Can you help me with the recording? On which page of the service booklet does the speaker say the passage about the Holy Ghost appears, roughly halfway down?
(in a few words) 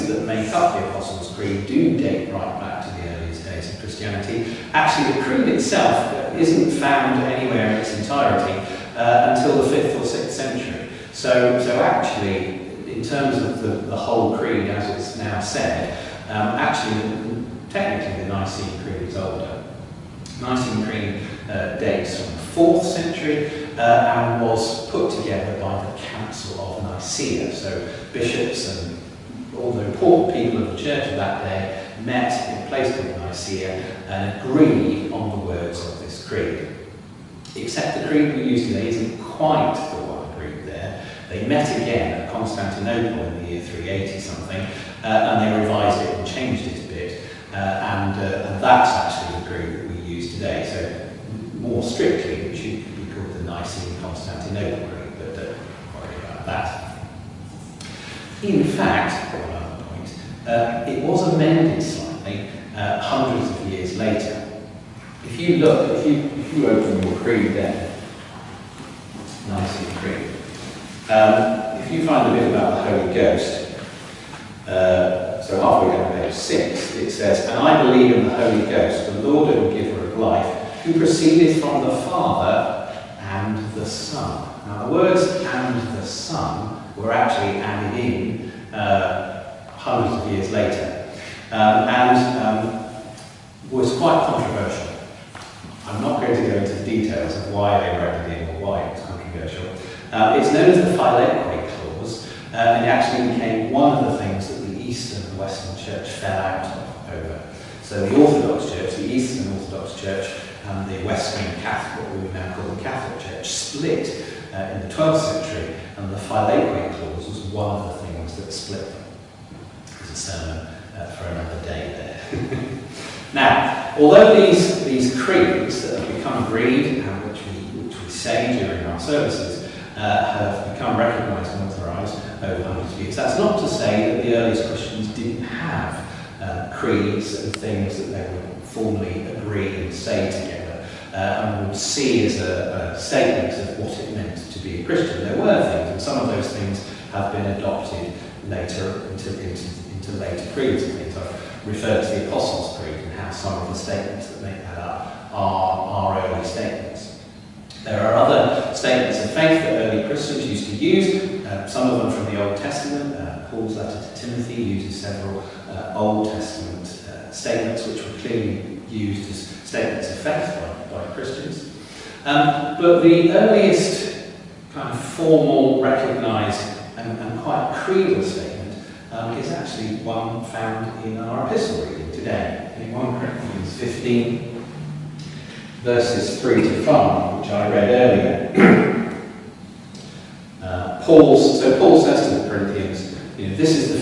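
6.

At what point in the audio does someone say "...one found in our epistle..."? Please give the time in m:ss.
3:00.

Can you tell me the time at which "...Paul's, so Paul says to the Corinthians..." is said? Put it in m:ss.
3:11.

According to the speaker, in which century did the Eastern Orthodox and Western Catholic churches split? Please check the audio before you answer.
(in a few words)
12th century.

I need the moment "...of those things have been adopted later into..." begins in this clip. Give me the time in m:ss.
2:26.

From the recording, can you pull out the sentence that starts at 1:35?
I'm not going to go into the details of why they were added in or why it was controversial.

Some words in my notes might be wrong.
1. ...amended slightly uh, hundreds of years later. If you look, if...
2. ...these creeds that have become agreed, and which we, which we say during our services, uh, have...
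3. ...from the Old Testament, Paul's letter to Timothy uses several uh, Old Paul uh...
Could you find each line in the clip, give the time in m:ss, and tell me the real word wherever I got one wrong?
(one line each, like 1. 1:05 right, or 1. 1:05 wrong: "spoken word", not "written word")
1. 1:01 right
2. 2:04 right
3. 2:42 wrong: "Testament", not "Paul".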